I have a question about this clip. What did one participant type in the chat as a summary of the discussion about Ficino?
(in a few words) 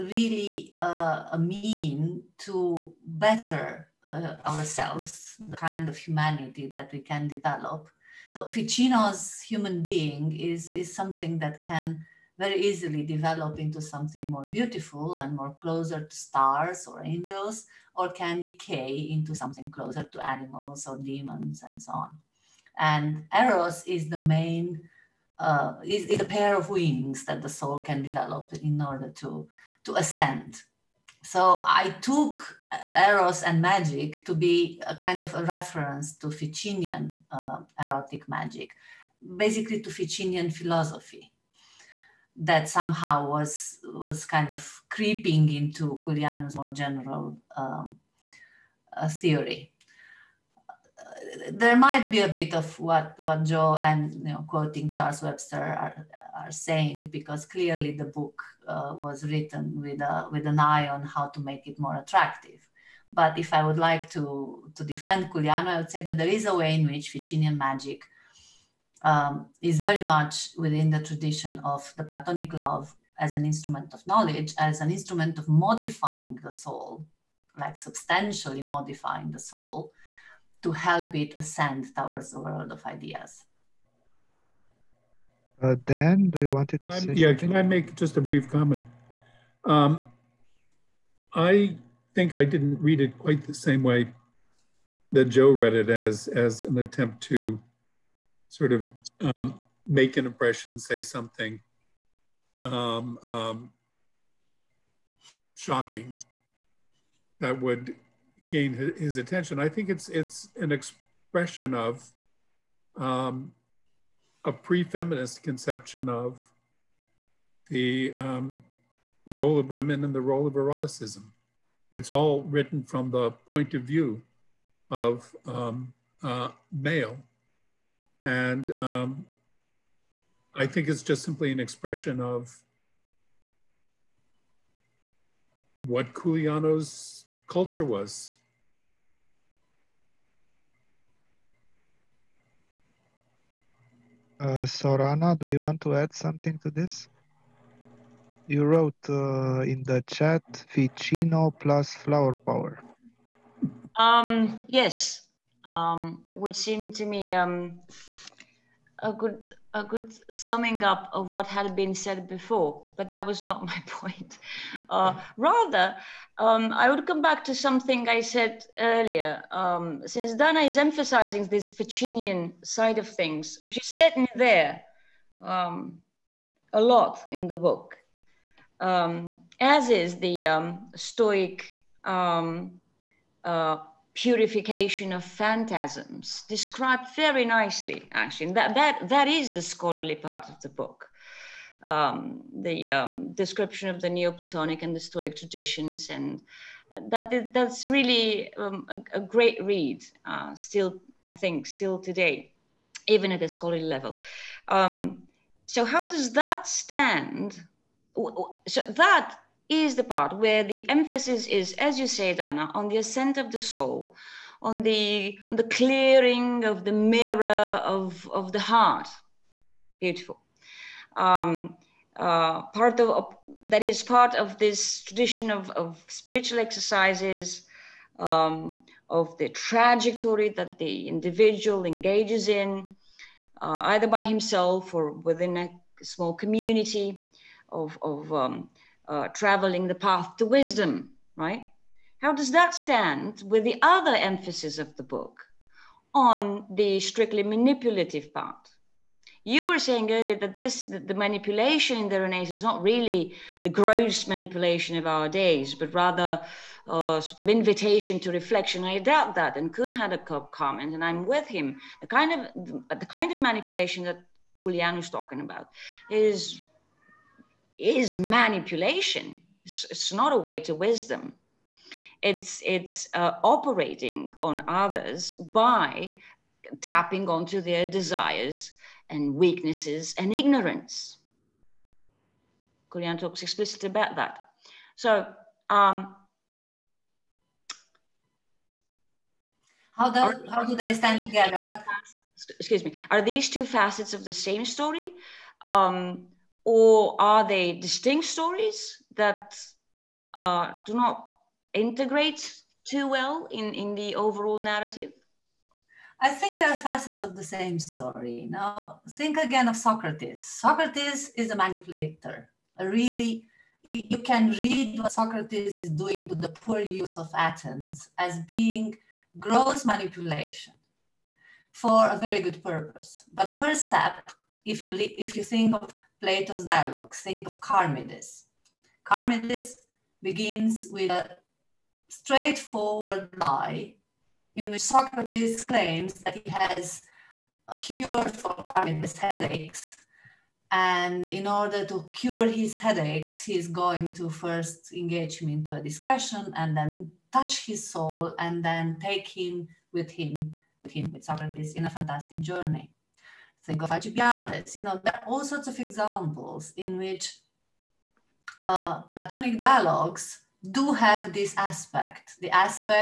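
Ficino plus flower power.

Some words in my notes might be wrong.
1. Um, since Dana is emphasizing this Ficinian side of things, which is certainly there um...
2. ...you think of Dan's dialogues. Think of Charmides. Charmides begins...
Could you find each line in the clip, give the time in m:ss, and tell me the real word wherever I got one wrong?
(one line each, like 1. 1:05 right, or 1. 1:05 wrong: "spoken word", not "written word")
1. 2:49 right
2. 5:25 wrong: "Plato", not "Dan".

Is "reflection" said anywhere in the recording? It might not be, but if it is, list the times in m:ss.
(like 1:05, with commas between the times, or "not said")
4:18.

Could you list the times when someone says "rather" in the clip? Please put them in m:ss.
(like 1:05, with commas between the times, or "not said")
2:45, 4:15.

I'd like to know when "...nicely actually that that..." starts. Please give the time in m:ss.
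3:07.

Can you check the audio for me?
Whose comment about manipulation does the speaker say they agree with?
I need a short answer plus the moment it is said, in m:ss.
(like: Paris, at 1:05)
Kuhn, at 4:19.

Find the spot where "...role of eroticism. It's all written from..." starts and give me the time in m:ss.
2:00.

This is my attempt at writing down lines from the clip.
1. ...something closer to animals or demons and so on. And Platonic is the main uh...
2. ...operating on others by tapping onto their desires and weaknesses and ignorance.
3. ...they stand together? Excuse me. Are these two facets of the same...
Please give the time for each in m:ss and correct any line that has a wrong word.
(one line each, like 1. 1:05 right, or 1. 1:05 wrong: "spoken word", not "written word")
1. 0:19 wrong: "Eros", not "Platonic"
2. 4:33 right
3. 4:50 right.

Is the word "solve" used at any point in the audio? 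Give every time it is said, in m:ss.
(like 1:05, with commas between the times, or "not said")
not said.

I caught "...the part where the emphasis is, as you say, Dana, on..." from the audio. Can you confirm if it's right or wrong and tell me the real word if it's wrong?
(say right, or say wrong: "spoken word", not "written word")
right.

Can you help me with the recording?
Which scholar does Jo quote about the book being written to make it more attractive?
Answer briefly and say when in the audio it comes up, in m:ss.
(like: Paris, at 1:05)
Charles Webster, at 0:54.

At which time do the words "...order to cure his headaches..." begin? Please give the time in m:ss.
5:41.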